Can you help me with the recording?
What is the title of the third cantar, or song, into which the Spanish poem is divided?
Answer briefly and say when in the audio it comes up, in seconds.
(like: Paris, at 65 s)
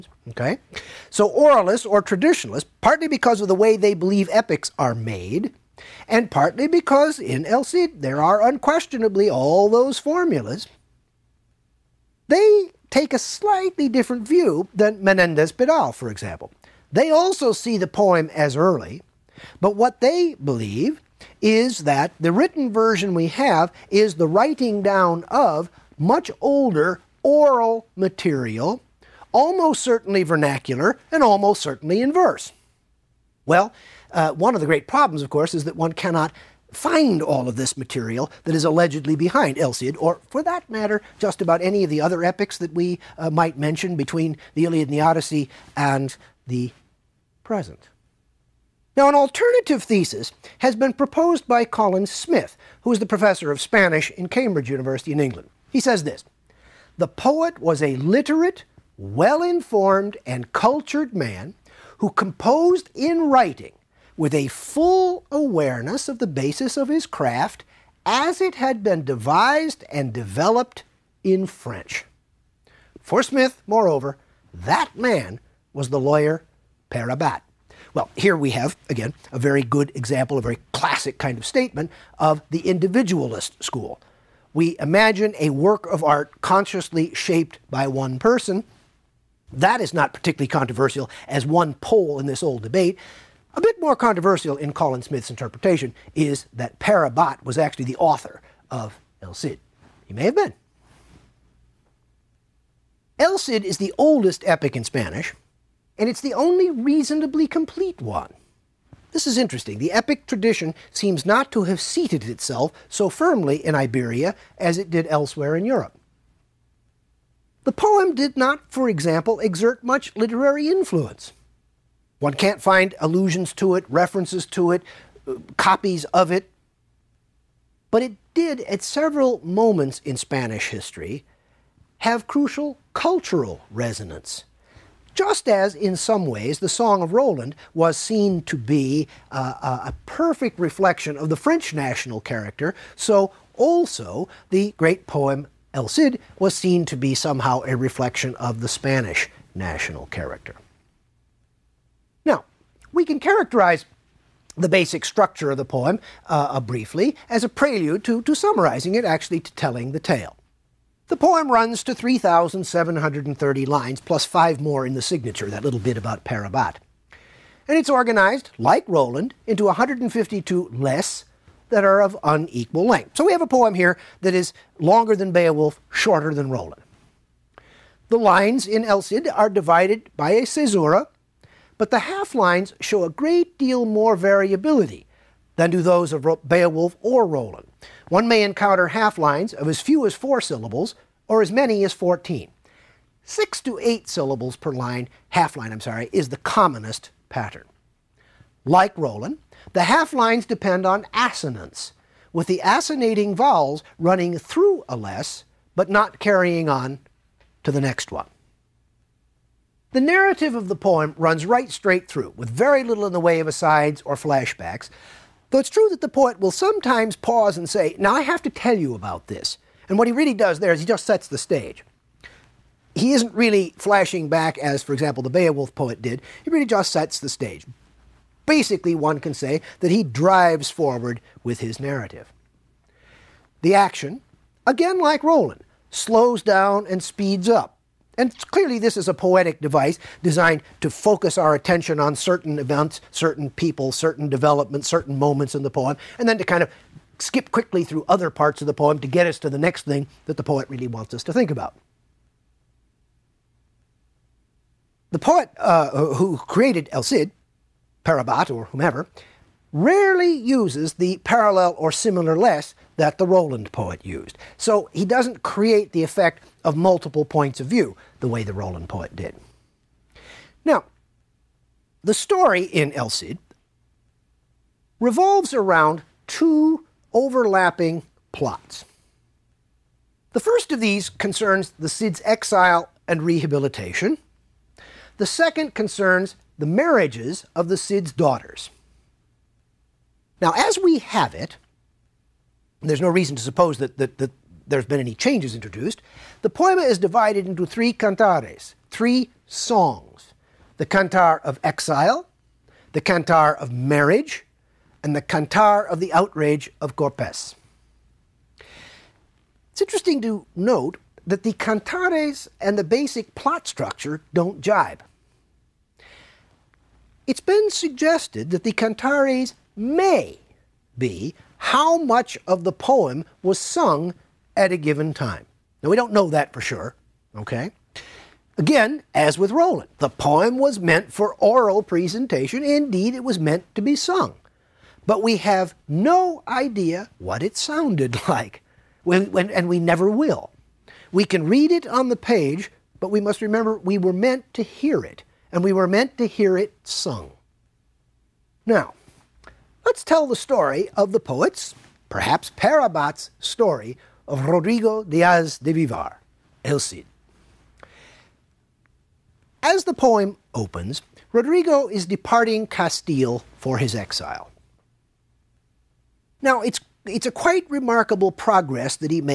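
the outrage of Corpes, at 305 s.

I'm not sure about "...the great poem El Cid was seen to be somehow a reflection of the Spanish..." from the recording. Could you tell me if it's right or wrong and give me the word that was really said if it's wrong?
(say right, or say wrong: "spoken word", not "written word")
right.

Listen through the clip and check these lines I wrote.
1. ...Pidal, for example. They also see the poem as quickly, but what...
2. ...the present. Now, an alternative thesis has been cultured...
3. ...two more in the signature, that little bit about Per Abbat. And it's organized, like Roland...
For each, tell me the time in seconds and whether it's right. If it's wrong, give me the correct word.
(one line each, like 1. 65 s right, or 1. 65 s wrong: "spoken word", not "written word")
1. 15 s wrong: "early", not "quickly"
2. 46 s wrong: "proposed", not "cultured"
3. 164 s wrong: "five", not "two".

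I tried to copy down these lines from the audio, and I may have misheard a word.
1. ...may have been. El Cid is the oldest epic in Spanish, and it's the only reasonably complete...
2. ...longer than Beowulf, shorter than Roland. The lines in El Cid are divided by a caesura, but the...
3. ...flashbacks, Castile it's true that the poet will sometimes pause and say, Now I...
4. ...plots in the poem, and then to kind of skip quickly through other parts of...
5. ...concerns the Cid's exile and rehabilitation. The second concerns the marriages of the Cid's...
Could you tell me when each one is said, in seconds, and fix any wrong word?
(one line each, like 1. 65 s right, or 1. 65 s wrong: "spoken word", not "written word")
1. 100 s right
2. 174 s right
3. 214 s wrong: "Though", not "Castile"
4. 245 s wrong: "moments", not "plots"
5. 281 s right.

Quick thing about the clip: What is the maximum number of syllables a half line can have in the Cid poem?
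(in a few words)
14.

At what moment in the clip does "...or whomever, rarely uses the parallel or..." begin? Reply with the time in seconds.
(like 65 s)
258 s.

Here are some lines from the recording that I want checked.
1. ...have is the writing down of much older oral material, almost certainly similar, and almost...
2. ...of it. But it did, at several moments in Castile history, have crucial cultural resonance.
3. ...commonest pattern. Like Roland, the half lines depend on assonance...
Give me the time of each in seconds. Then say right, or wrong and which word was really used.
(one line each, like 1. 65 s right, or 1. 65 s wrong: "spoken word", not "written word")
1. 23 s wrong: "vernacular", not "similar"
2. 126 s wrong: "Spanish", not "Castile"
3. 196 s right.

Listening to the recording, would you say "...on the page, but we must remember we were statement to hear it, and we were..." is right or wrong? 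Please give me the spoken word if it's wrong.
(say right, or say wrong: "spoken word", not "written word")
wrong: "meant", not "statement".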